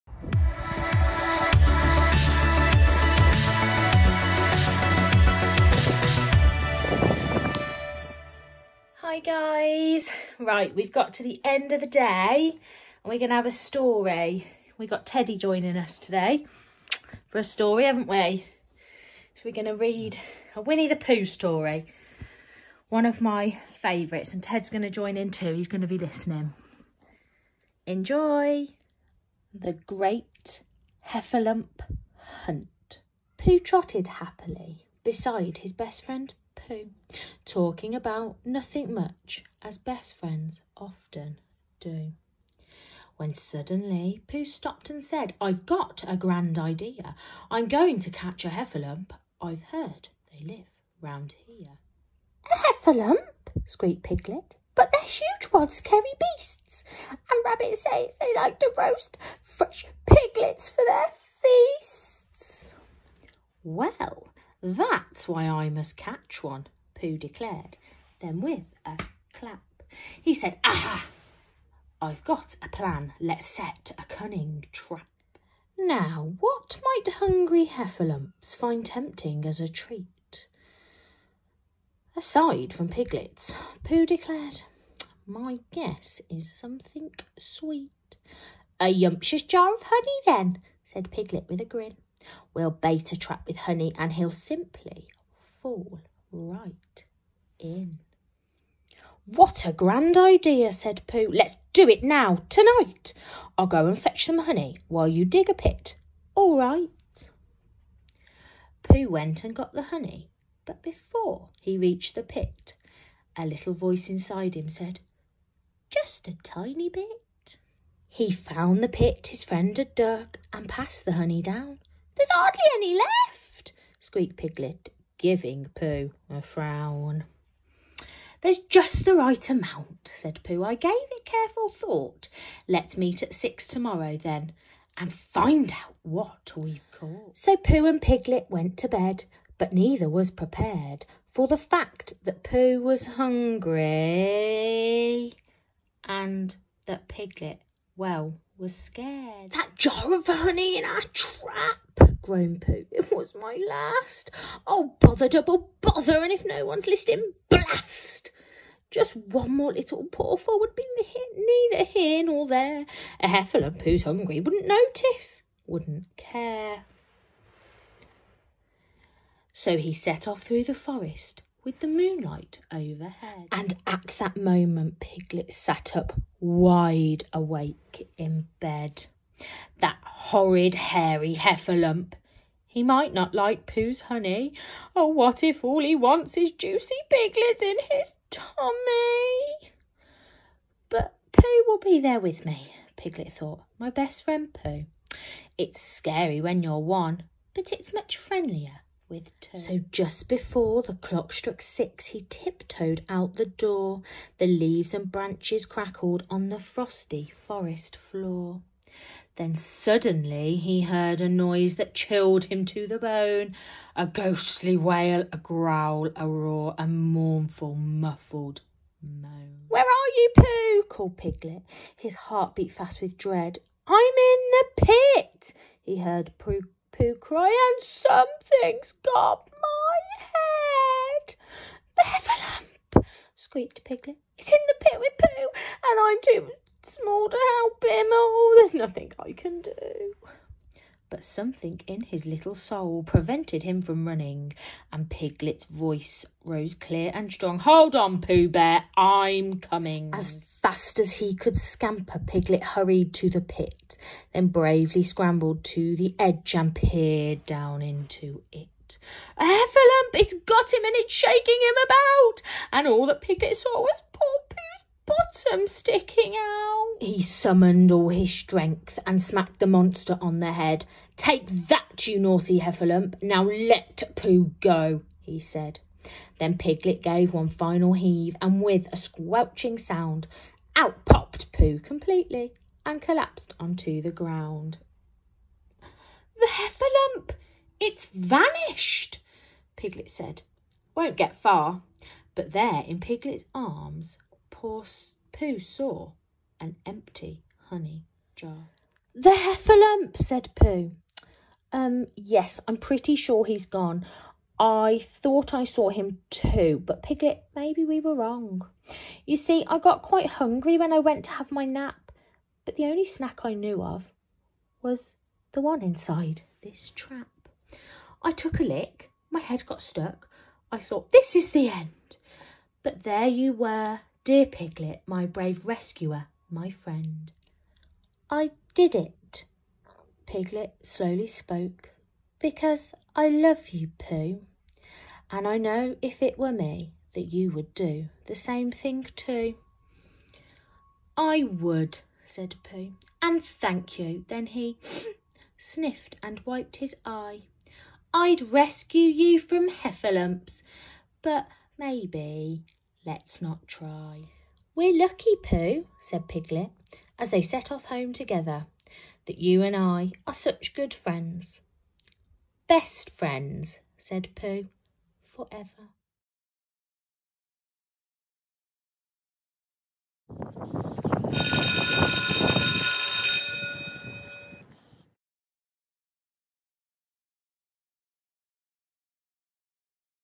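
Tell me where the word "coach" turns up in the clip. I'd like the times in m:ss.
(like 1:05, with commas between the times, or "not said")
not said.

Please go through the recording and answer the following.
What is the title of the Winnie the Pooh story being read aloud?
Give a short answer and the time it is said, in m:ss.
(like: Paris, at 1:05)
The Great Heffalump Hunt, at 0:29.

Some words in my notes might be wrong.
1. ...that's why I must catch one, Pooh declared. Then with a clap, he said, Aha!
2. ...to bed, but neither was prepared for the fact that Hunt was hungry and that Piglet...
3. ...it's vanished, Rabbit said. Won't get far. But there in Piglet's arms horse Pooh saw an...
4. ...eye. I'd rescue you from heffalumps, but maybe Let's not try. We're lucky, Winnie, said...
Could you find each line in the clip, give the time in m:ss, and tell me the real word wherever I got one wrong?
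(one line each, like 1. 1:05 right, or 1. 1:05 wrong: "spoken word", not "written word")
1. 1:04 right
2. 2:18 wrong: "Pooh", not "Hunt"
3. 4:47 wrong: "Piglet", not "Rabbit"
4. 5:47 wrong: "Pooh", not "Winnie".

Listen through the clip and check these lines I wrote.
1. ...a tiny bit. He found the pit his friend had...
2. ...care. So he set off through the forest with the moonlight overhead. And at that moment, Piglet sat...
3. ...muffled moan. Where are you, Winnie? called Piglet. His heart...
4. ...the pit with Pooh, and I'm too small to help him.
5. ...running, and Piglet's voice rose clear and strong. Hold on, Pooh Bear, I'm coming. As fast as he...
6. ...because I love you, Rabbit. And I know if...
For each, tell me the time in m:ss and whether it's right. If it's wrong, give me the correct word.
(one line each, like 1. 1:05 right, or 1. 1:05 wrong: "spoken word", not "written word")
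1. 1:56 right
2. 2:46 right
3. 3:37 wrong: "Pooh", not "Winnie"
4. 3:54 right
5. 4:04 right
6. 5:32 wrong: "Pooh", not "Rabbit".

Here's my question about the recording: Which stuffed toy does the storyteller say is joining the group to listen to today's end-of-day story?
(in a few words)
Teddy.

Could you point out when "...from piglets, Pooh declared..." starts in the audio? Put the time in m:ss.
1:22.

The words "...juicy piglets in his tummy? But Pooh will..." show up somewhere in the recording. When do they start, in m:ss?
3:06.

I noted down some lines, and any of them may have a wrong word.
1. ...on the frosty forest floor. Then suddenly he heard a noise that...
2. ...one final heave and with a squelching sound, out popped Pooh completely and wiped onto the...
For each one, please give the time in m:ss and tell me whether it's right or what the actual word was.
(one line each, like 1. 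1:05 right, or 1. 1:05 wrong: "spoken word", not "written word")
1. 3:26 right
2. 4:37 wrong: "collapsed", not "wiped".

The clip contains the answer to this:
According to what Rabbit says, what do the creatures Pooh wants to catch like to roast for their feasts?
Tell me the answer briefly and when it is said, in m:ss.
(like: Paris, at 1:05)
fresh piglets, at 0:59.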